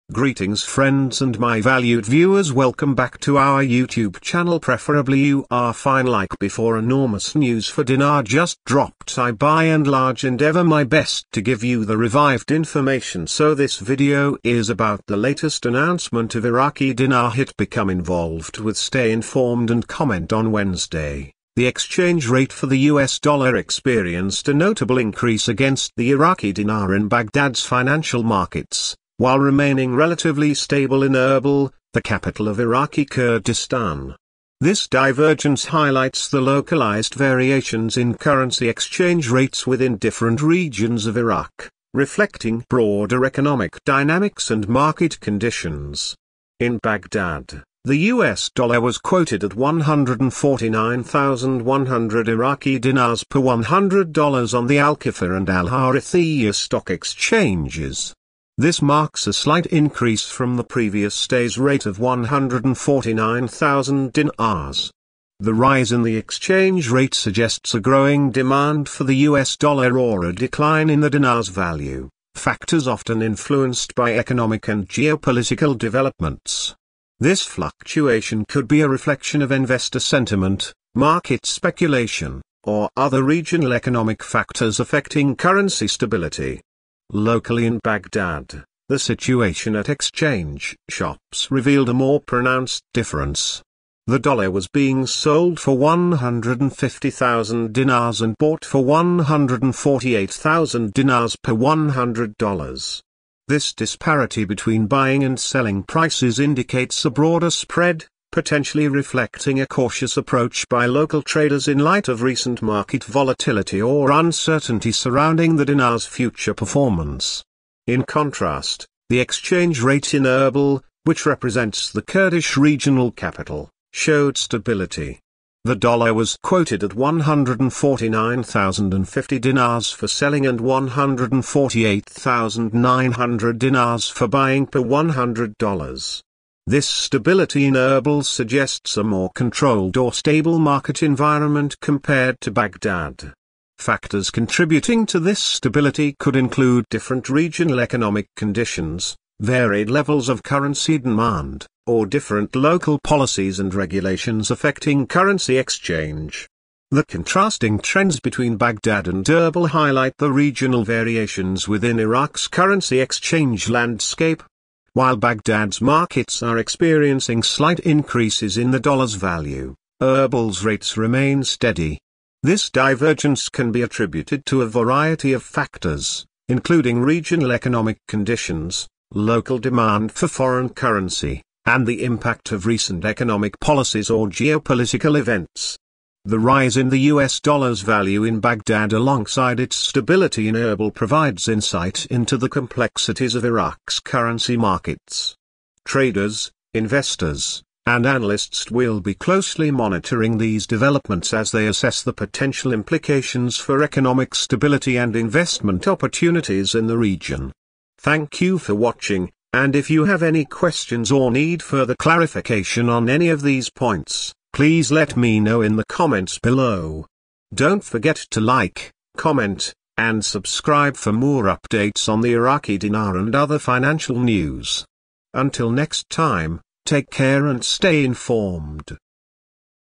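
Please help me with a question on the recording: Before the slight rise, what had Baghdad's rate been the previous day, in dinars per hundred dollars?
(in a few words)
149,000.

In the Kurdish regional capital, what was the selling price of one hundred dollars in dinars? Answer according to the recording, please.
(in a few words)
149,050.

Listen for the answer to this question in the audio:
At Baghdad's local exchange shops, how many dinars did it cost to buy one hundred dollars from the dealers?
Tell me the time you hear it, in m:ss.
1:35.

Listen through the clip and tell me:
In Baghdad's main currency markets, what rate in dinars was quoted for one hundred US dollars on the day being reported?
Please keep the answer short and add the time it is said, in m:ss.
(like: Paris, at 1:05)
149,100, at 0:49.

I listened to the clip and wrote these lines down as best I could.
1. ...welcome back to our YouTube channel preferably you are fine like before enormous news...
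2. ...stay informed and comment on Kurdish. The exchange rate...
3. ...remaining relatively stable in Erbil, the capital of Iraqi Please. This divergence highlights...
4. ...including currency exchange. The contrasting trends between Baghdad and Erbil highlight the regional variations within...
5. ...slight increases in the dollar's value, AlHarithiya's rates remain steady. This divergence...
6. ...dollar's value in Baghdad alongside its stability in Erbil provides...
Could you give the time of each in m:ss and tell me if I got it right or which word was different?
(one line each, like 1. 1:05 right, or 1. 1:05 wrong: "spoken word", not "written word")
1. 0:02 right
2. 0:18 wrong: "Wednesday", not "Kurdish"
3. 0:29 wrong: "Kurdistan", not "Please"
4. 2:34 wrong: "affecting", not "including"
5. 2:47 wrong: "Erbil", not "AlHarithiya"
6. 3:07 right.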